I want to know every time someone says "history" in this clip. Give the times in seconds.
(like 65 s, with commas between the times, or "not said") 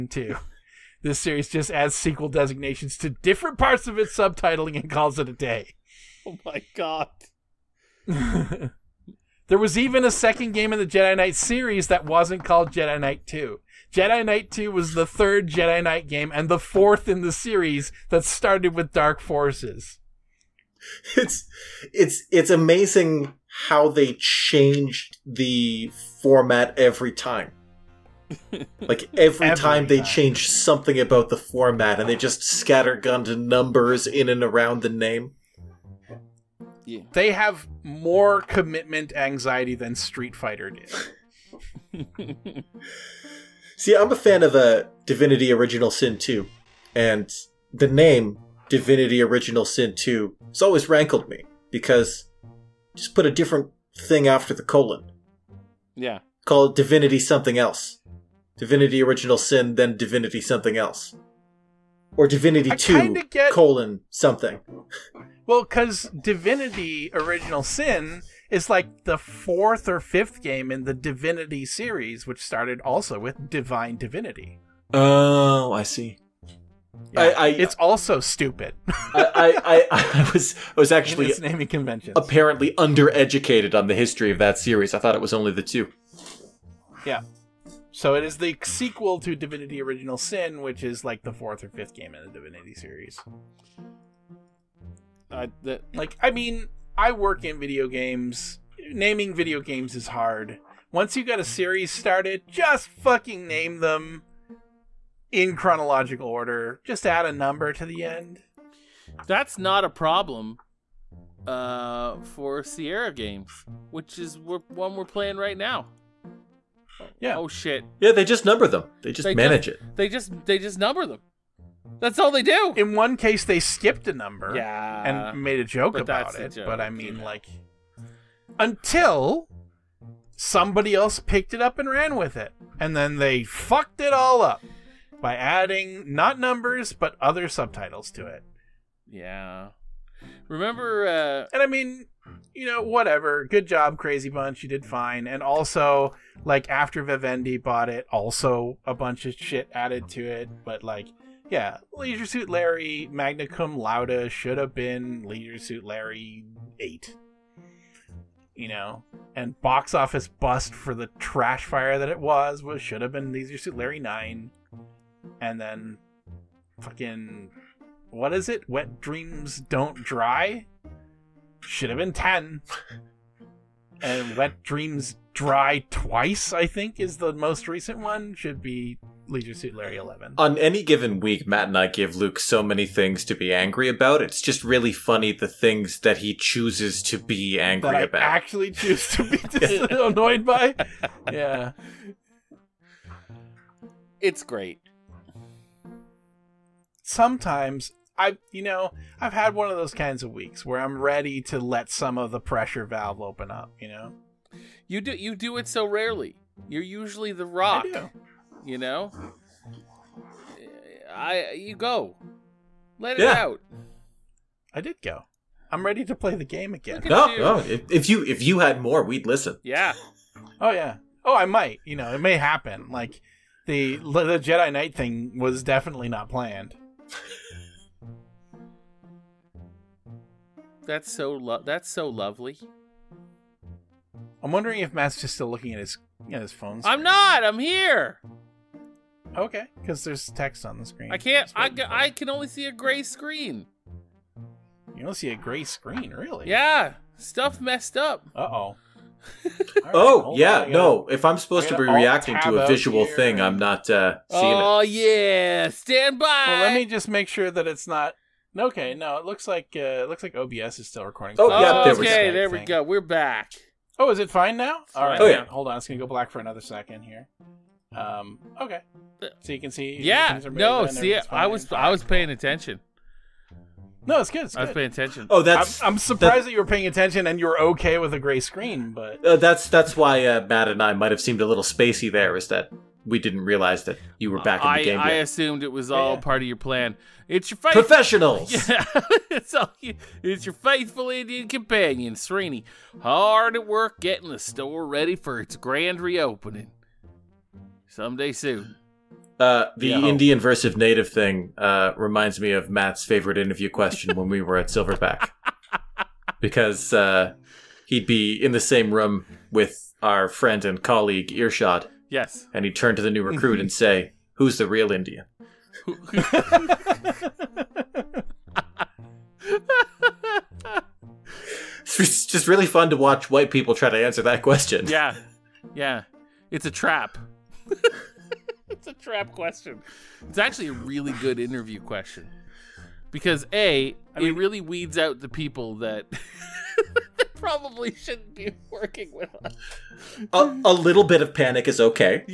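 83 s.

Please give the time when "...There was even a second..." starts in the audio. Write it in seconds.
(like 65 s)
9 s.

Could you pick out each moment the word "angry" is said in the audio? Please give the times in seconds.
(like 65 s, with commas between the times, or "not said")
183 s, 187 s.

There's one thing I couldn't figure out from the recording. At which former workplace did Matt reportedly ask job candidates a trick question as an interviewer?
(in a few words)
Silverback.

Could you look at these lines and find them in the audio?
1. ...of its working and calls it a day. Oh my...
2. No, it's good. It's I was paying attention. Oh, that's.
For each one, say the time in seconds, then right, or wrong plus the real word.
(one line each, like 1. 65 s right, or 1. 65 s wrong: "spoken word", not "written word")
1. 3 s wrong: "subtitling", not "working"
2. 274 s right.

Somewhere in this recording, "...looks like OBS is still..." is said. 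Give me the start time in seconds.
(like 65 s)
260 s.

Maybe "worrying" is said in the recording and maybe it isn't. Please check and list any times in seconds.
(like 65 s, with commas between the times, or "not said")
not said.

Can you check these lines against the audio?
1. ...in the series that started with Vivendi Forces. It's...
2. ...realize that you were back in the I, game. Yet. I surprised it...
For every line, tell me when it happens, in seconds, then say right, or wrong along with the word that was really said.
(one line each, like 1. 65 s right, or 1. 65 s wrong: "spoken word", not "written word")
1. 17 s wrong: "Dark", not "Vivendi"
2. 283 s wrong: "assumed", not "surprised".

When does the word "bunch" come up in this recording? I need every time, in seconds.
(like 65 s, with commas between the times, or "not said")
144 s, 148 s.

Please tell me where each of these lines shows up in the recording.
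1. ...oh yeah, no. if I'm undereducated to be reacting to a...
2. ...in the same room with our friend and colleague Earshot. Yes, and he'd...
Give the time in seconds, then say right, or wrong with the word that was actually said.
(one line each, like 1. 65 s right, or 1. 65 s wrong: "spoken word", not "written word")
1. 249 s wrong: "supposed", not "undereducated"
2. 308 s right.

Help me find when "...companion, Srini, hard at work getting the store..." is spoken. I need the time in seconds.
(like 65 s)
291 s.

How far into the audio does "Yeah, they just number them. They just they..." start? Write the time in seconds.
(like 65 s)
118 s.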